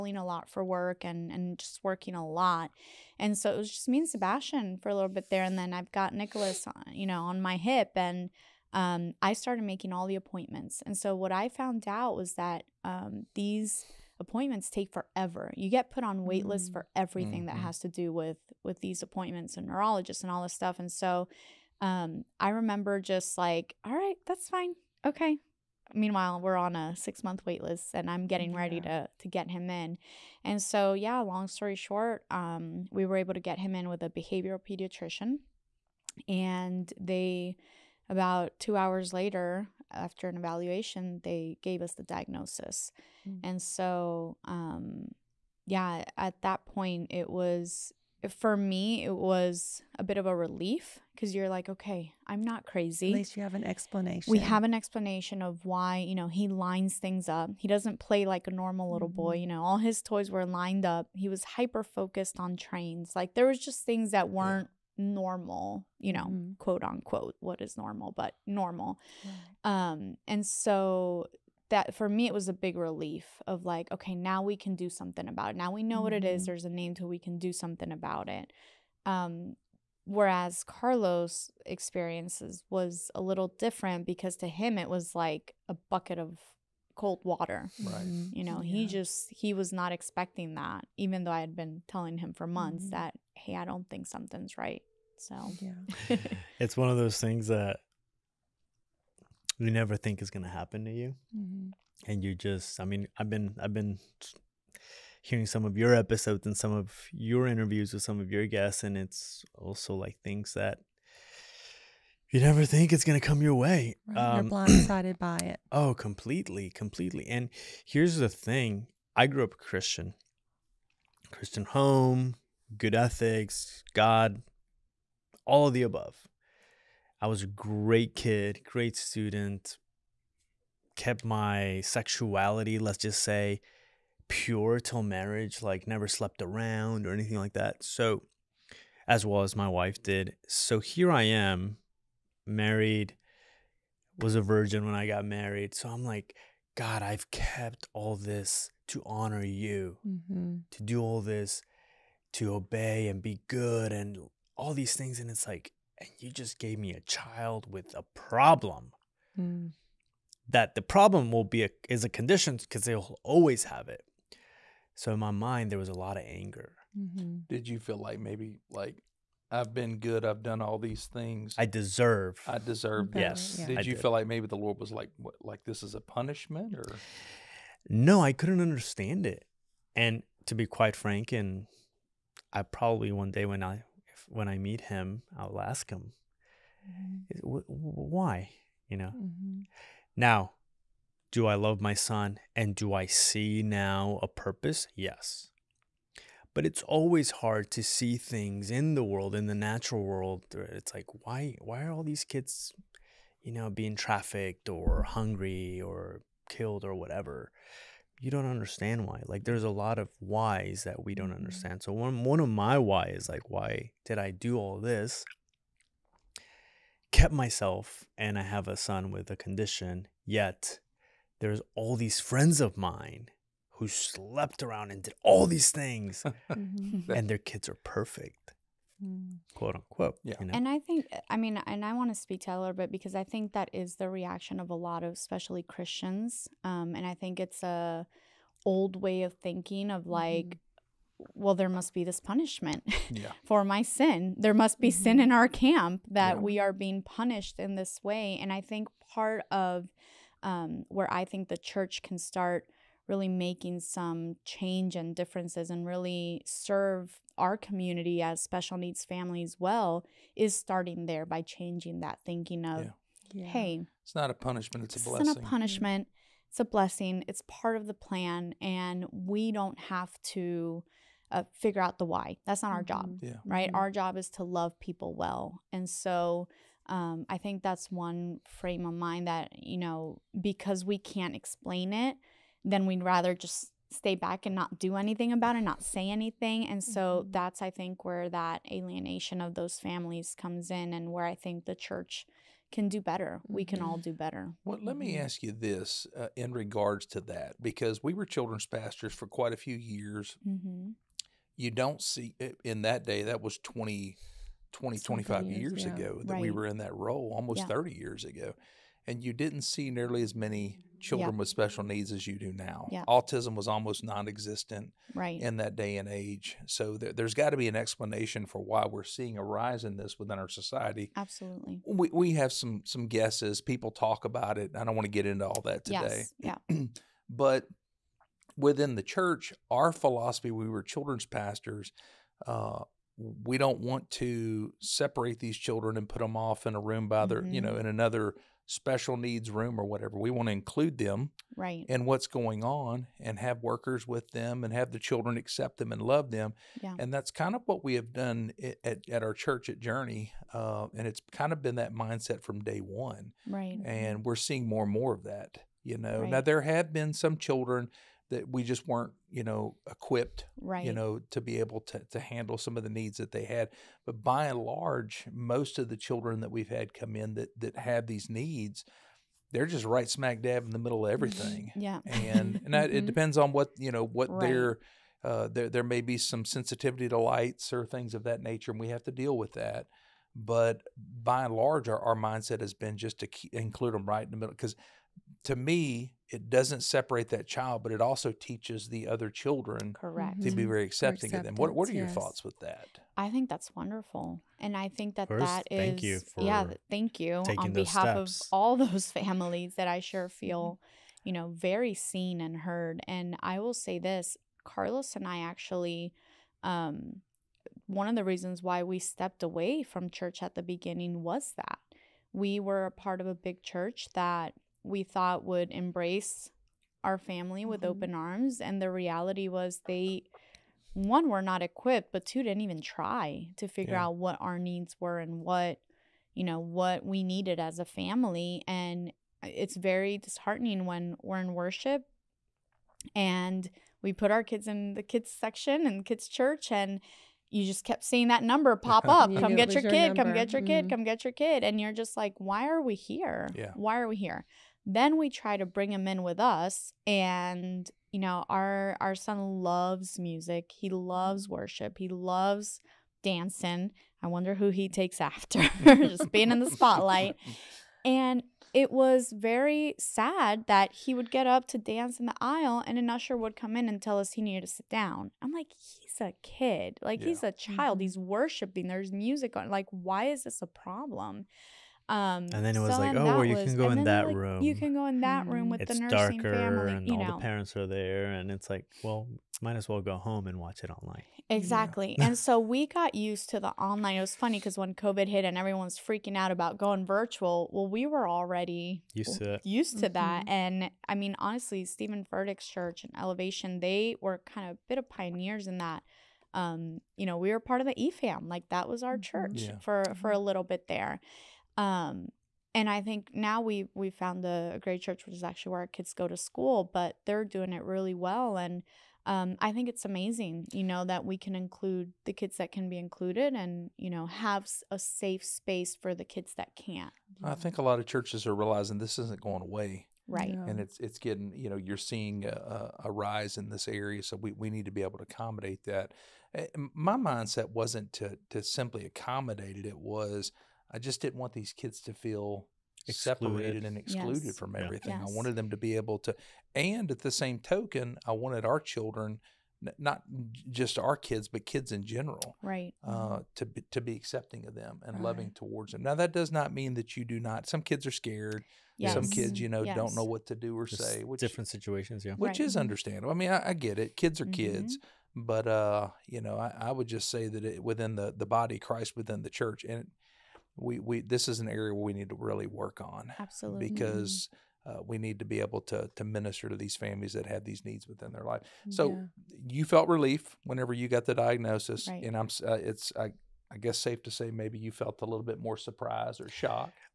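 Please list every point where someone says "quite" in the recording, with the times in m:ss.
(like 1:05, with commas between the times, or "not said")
3:00, 4:59.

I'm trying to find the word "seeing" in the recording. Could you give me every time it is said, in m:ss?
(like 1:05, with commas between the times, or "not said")
5:19, 5:54, 7:18, 8:41.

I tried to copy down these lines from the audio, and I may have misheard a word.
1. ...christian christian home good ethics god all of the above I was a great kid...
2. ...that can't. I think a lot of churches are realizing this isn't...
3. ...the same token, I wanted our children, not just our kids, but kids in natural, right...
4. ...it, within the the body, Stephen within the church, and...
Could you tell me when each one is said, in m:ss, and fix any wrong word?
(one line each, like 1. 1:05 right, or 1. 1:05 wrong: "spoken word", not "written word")
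1. 1:59 right
2. 8:36 right
3. 8:57 wrong: "general", not "natural"
4. 9:17 wrong: "Christ", not "Stephen".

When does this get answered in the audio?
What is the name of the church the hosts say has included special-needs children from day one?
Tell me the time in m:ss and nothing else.
5:49.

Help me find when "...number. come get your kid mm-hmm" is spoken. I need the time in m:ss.
7:20.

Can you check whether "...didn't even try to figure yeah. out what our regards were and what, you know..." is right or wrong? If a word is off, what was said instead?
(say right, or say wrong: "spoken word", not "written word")
wrong: "needs", not "regards".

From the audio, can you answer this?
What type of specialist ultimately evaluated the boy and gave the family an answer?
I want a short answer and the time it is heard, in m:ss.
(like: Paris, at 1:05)
behavioral pediatrician, at 0:34.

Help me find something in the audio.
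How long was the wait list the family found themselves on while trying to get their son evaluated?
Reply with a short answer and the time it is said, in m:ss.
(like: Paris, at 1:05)
six month, at 0:26.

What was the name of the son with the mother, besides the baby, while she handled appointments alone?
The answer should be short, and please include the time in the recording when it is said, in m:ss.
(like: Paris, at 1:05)
Sebastian, at 0:04.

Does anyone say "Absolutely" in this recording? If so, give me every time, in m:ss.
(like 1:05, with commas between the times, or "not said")
5:21, 9:23.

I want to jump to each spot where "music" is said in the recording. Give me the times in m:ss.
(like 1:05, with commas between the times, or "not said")
7:30, 7:49.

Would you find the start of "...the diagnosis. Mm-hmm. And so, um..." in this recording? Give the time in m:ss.
0:41.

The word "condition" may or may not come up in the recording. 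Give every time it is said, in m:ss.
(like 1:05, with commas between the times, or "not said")
2:42, 3:39.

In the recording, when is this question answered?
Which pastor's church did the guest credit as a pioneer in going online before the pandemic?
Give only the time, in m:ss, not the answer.
8:11.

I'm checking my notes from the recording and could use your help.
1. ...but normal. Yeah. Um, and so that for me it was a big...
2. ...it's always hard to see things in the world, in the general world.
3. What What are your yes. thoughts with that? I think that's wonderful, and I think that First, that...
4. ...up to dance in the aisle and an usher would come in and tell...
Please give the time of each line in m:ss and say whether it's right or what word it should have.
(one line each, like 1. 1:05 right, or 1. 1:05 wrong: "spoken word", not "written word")
1. 1:08 right
2. 3:16 wrong: "natural", not "general"
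3. 6:31 right
4. 7:41 right.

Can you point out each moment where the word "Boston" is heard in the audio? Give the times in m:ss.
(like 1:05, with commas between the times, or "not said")
not said.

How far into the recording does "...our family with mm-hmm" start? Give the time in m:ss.
6:57.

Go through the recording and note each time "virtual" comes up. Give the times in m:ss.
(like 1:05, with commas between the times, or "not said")
8:07.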